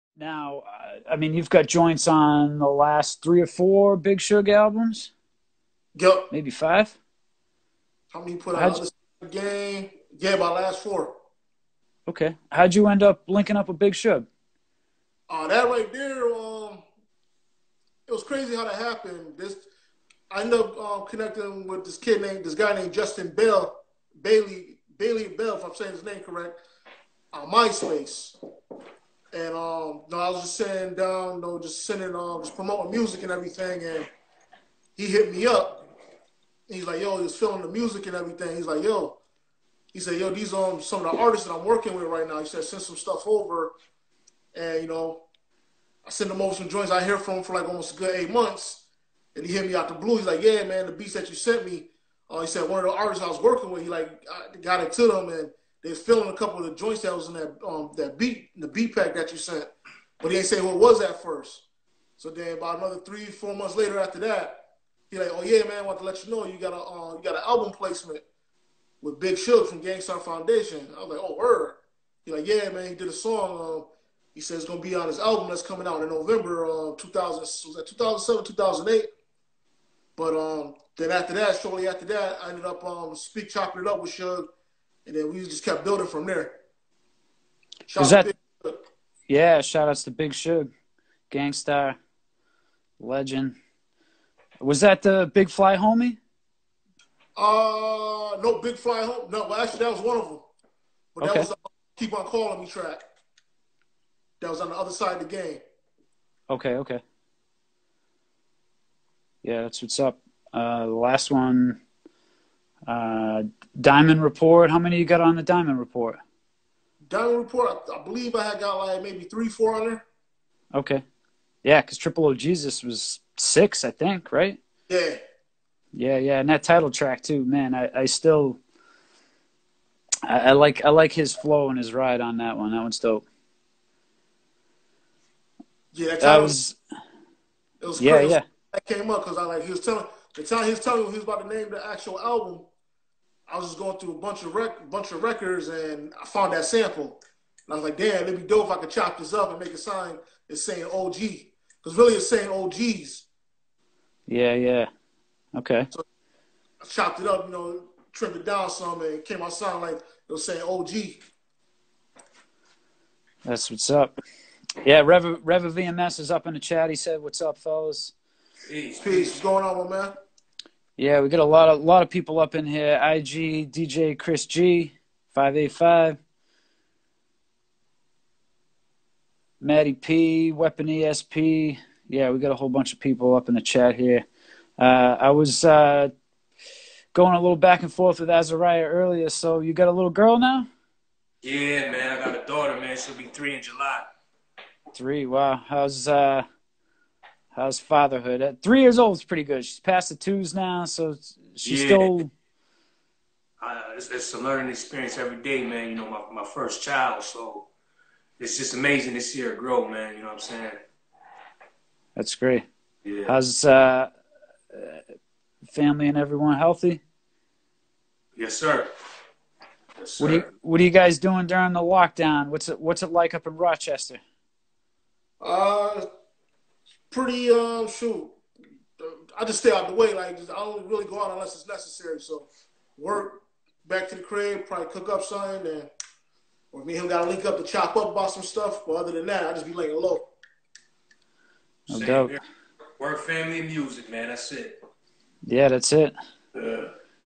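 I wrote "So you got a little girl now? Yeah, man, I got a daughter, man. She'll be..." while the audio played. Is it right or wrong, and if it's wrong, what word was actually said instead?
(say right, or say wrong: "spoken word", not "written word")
right.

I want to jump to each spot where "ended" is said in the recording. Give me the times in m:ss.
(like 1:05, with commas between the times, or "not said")
0:20, 1:22.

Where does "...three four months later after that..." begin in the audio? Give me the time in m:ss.
1:02.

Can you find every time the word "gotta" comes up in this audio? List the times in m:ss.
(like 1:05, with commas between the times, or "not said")
3:57.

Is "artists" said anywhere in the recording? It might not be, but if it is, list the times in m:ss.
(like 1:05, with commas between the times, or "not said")
0:41, 0:52.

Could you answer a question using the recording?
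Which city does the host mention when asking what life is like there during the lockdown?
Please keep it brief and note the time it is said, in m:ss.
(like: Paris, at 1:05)
Rochester, at 3:43.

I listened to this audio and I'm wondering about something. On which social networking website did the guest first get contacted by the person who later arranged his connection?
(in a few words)
MySpace.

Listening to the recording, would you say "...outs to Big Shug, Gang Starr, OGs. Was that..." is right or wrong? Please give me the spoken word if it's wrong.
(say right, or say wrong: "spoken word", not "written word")
wrong: "Legend", not "OGs".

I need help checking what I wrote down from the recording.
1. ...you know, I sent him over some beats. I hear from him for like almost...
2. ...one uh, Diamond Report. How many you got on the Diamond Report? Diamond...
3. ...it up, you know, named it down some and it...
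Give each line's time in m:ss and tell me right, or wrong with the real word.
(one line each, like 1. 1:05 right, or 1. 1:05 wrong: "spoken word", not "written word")
1. 0:44 wrong: "joints", not "beats"
2. 1:51 right
3. 2:37 wrong: "trimmed", not "named".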